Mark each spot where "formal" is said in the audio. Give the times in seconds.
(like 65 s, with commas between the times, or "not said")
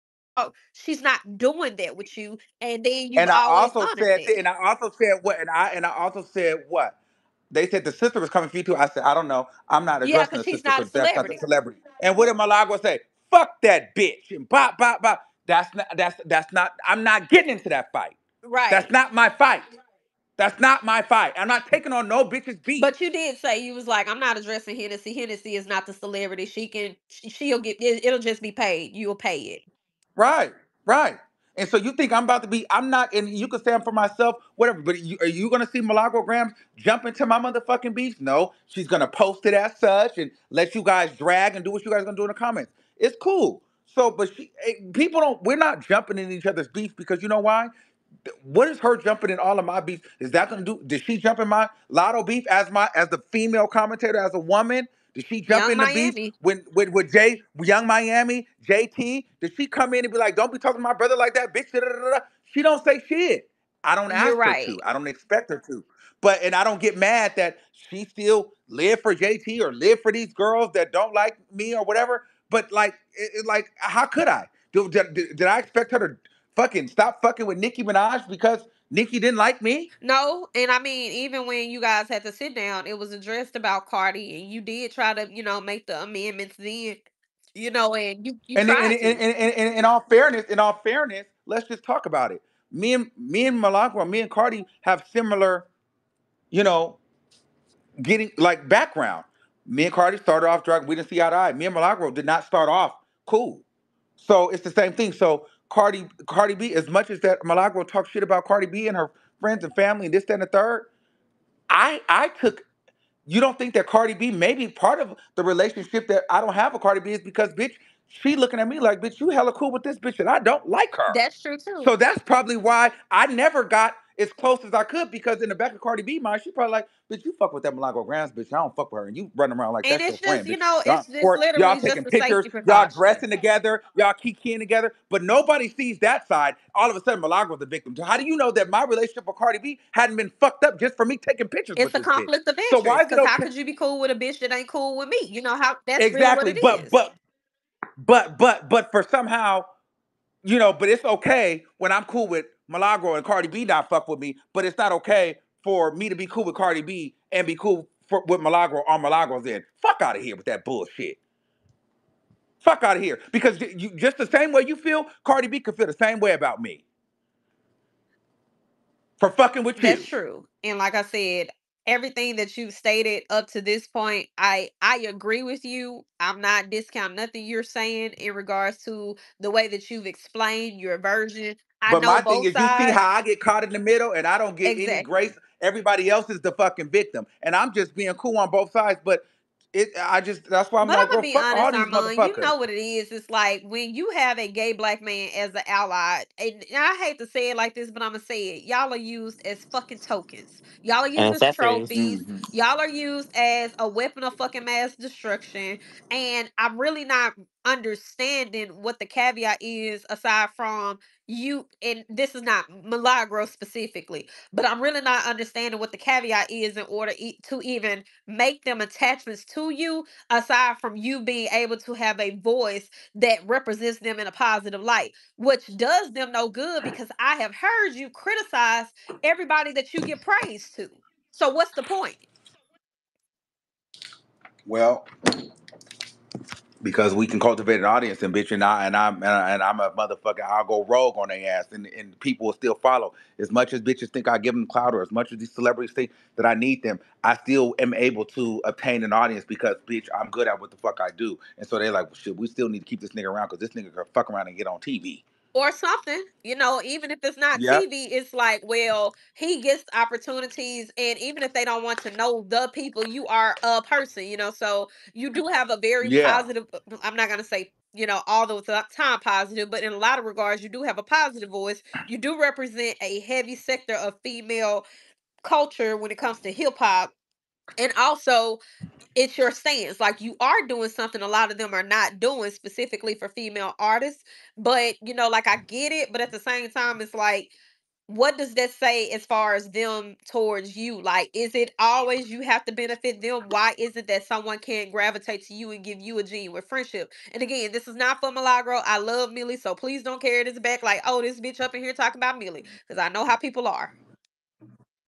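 not said.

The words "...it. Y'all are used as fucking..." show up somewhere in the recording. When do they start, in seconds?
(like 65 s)
198 s.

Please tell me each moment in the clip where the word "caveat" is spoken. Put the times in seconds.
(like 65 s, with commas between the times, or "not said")
209 s, 215 s.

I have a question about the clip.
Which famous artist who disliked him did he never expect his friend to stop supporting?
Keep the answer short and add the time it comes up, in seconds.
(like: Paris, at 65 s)
Nicki Minaj, at 77 s.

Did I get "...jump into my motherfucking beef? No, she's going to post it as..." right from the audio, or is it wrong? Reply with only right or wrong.
right.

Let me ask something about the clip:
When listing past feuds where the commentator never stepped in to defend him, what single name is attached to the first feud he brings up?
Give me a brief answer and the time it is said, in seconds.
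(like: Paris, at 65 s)
Lotto, at 51 s.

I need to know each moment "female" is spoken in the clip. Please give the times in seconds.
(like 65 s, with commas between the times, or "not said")
53 s, 274 s, 283 s.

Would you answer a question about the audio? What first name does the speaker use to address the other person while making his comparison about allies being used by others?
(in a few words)
Armon.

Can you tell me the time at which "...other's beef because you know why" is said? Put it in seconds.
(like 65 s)
46 s.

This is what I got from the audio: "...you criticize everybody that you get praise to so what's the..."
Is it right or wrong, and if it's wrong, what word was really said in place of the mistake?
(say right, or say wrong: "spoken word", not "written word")
right.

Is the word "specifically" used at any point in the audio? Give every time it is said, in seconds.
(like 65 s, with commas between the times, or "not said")
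213 s, 282 s.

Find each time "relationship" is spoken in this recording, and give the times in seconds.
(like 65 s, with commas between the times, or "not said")
115 s, 138 s.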